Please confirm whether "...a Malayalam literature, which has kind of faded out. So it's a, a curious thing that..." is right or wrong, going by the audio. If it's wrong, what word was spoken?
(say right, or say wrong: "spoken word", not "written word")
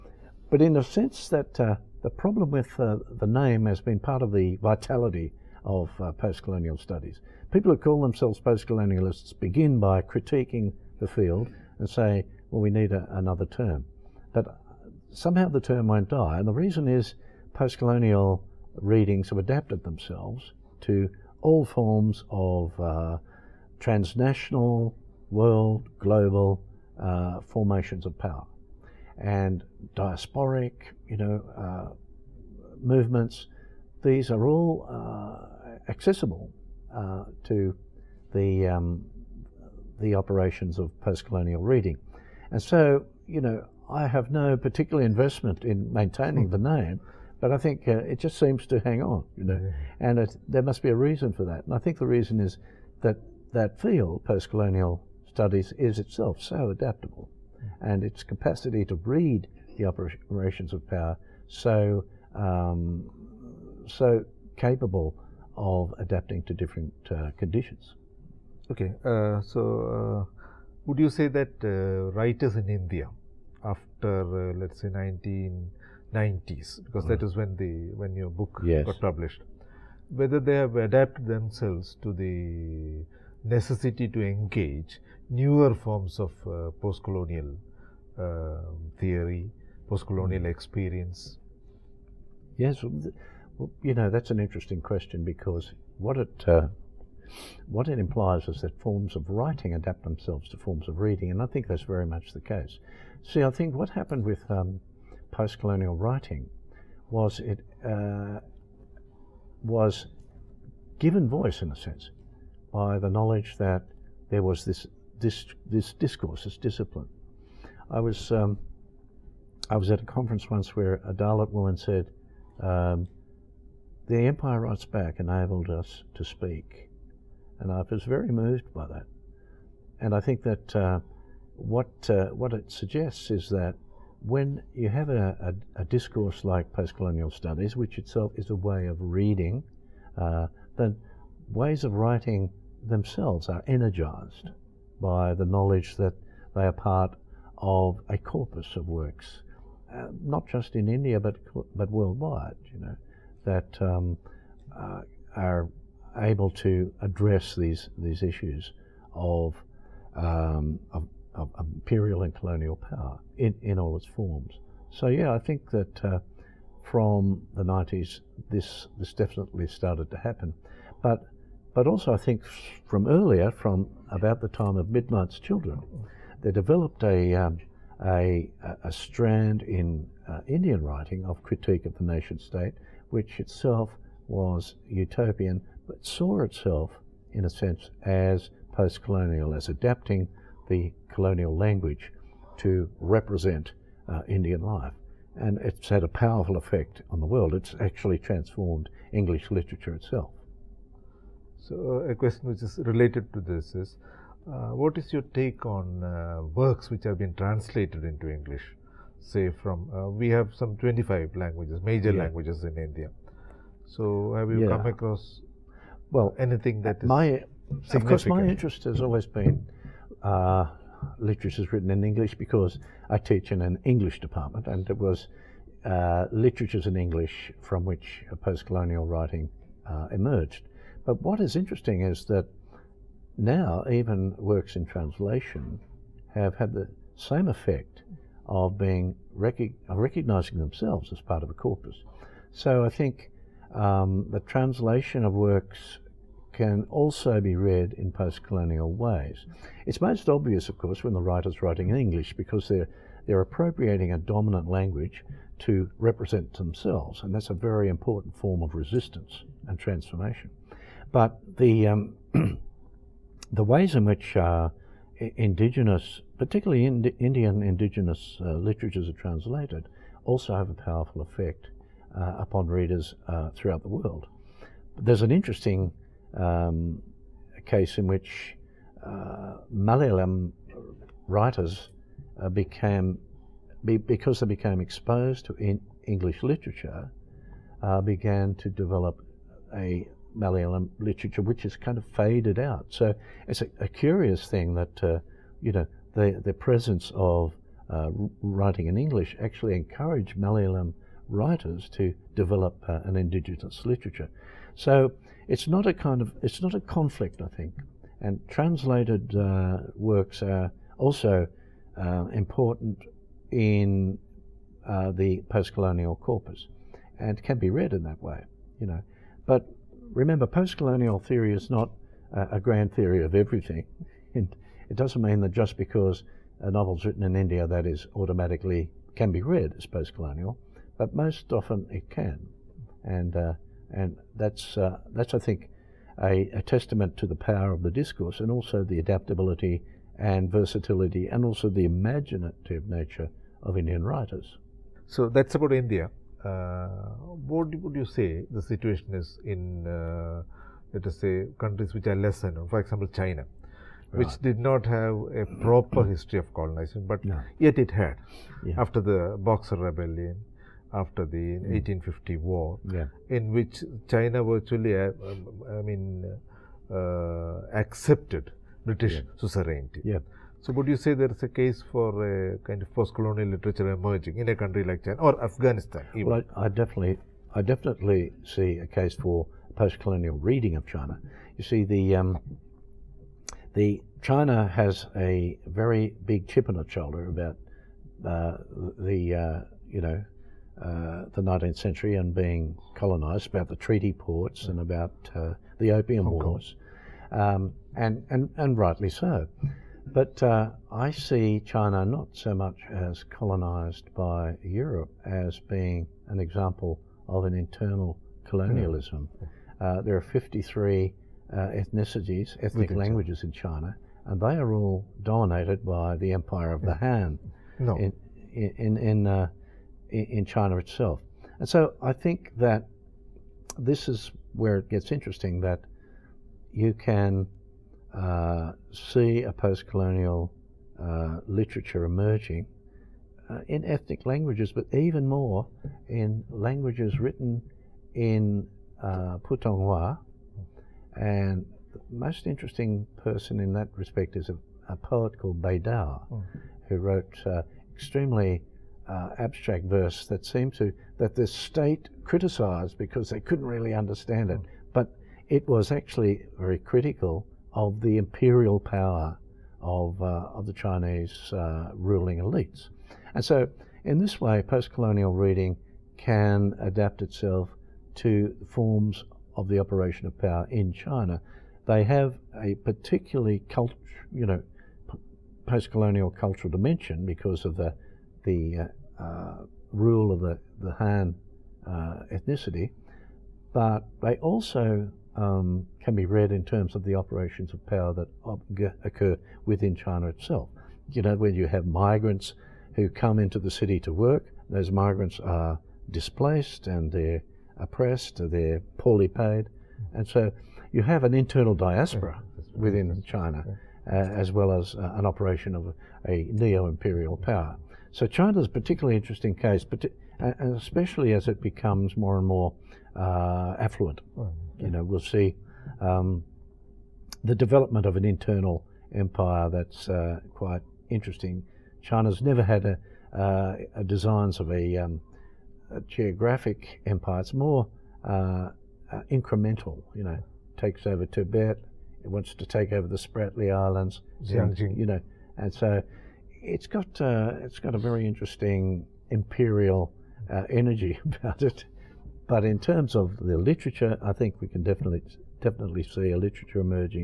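right.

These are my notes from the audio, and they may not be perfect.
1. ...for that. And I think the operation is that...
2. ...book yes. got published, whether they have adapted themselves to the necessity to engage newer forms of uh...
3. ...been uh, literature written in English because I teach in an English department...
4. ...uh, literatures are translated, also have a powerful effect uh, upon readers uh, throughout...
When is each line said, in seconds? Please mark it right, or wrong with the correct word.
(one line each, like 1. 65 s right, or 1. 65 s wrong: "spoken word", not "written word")
1. 51 s wrong: "reason", not "operation"
2. 78 s right
3. 219 s right
4. 268 s right.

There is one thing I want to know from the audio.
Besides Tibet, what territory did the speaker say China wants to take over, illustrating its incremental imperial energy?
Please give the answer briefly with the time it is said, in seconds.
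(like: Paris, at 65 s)
Spratly Islands, at 533 s.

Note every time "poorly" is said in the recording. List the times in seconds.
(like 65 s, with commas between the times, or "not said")
498 s.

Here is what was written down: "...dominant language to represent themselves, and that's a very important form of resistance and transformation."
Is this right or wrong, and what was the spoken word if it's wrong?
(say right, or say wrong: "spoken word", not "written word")
right.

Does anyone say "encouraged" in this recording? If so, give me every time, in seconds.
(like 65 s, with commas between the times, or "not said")
299 s.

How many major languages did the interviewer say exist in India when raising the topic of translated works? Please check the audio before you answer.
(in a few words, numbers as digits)
25.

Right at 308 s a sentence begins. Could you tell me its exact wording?
And translated uh, works are also uh, important in uh, the post-colonial corpus and can be read in that way, you know.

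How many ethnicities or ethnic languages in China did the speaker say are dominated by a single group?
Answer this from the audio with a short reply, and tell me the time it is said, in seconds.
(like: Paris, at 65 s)
53, at 410 s.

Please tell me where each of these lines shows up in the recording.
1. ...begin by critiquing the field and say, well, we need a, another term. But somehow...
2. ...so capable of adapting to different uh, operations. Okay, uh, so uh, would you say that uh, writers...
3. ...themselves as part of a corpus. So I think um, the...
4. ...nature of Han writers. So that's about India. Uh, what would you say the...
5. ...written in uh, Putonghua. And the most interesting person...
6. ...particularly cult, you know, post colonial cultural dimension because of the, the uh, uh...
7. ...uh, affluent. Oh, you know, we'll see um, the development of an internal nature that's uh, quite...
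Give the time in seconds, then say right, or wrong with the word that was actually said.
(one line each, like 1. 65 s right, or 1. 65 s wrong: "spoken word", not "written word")
1. 9 s right
2. 63 s wrong: "conditions", not "operations"
3. 240 s right
4. 342 s wrong: "Indian", not "Han"
5. 437 s right
6. 472 s right
7. 513 s wrong: "empire", not "nature".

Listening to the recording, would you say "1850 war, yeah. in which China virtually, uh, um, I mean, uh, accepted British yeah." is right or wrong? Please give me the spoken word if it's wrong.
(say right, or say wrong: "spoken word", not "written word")
right.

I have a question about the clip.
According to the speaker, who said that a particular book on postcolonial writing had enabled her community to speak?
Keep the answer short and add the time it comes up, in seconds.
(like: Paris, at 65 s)
A Dalit woman, at 121 s.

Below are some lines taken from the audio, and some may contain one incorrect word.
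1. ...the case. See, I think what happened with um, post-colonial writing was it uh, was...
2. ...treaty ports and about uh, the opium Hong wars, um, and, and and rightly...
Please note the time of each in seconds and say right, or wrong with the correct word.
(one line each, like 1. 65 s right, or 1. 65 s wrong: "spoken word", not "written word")
1. 102 s right
2. 393 s right.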